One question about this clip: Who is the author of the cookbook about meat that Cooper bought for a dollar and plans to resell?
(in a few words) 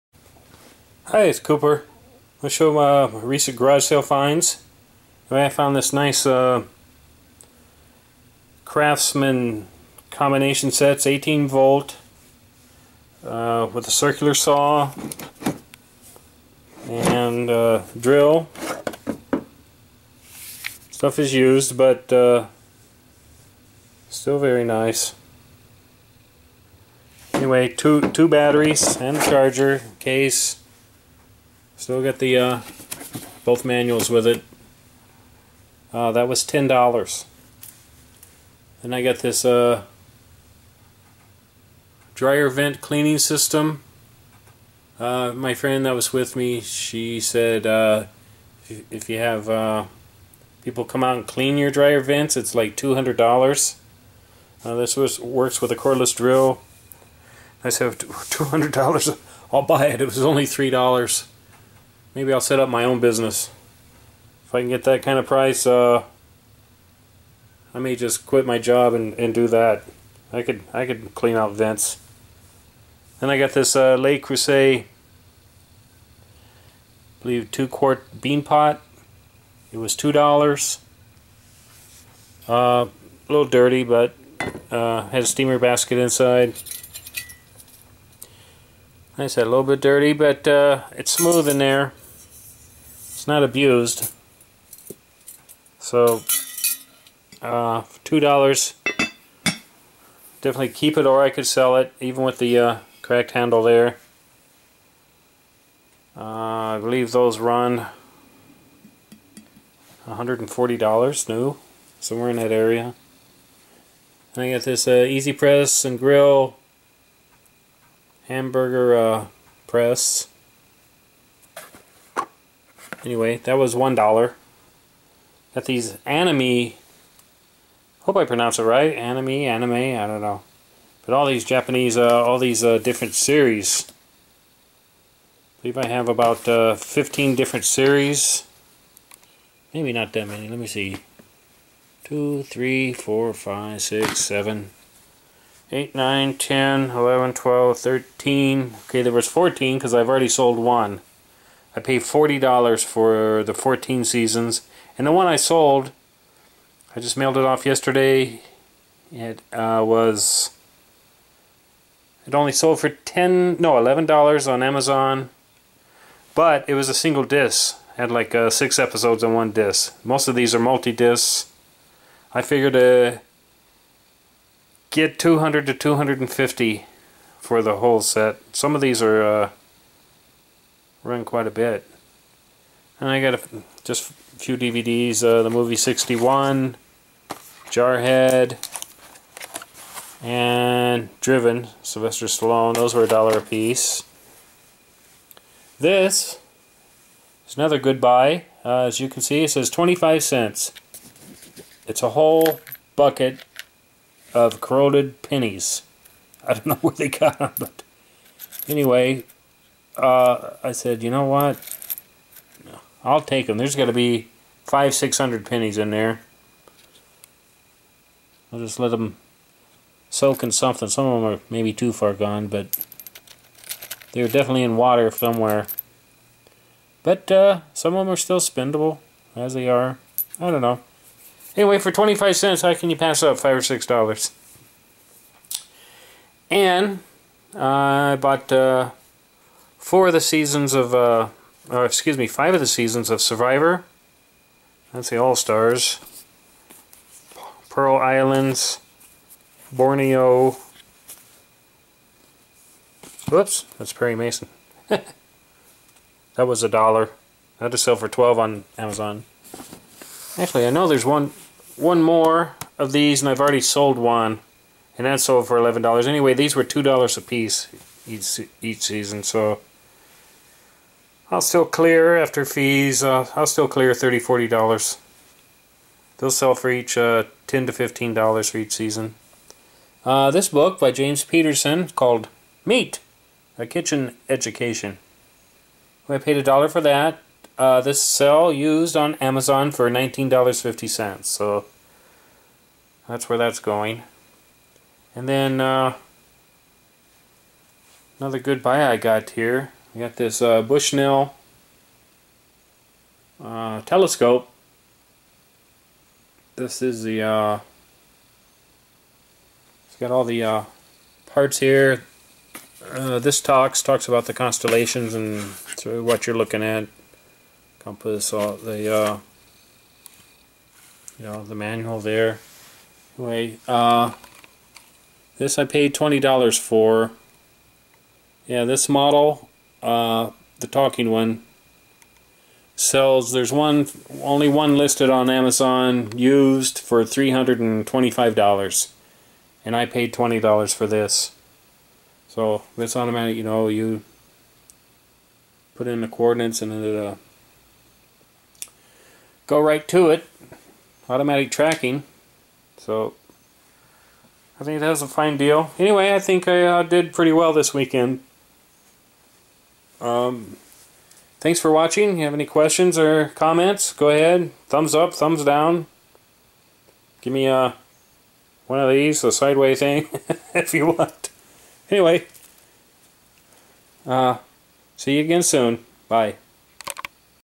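James Peterson.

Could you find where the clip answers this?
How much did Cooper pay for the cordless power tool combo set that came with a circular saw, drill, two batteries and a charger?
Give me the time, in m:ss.
0:36.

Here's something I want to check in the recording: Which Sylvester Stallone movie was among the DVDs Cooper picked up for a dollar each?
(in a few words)
Driven.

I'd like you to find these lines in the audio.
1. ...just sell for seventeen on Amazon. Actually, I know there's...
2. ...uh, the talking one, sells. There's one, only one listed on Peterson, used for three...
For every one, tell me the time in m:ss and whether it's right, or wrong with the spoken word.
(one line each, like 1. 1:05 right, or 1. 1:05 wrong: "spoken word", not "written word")
1. 4:17 wrong: "twelve", not "seventeen"
2. 5:29 wrong: "Amazon", not "Peterson".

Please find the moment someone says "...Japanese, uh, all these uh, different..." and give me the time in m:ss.
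2:11.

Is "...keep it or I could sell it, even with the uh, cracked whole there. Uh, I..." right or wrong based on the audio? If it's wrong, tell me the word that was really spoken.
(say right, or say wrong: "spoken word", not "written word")
wrong: "handle", not "whole".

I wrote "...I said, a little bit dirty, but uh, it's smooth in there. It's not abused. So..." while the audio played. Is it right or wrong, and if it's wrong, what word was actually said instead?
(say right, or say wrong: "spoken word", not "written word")
right.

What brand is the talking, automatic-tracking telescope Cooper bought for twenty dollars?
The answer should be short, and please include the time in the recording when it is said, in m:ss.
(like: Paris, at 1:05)
Bushnell, at 5:00.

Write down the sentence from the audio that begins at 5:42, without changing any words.
So this automatic, you know, you put in the coordinates and it'll uh, go right to it.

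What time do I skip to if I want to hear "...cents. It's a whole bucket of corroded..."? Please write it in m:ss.
3:20.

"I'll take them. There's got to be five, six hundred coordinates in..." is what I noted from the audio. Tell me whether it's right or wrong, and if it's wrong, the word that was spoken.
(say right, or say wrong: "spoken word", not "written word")
wrong: "pennies", not "coordinates".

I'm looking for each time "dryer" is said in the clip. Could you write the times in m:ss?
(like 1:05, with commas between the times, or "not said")
0:42, 0:51.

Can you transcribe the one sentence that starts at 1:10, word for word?
I could I could clean out vents.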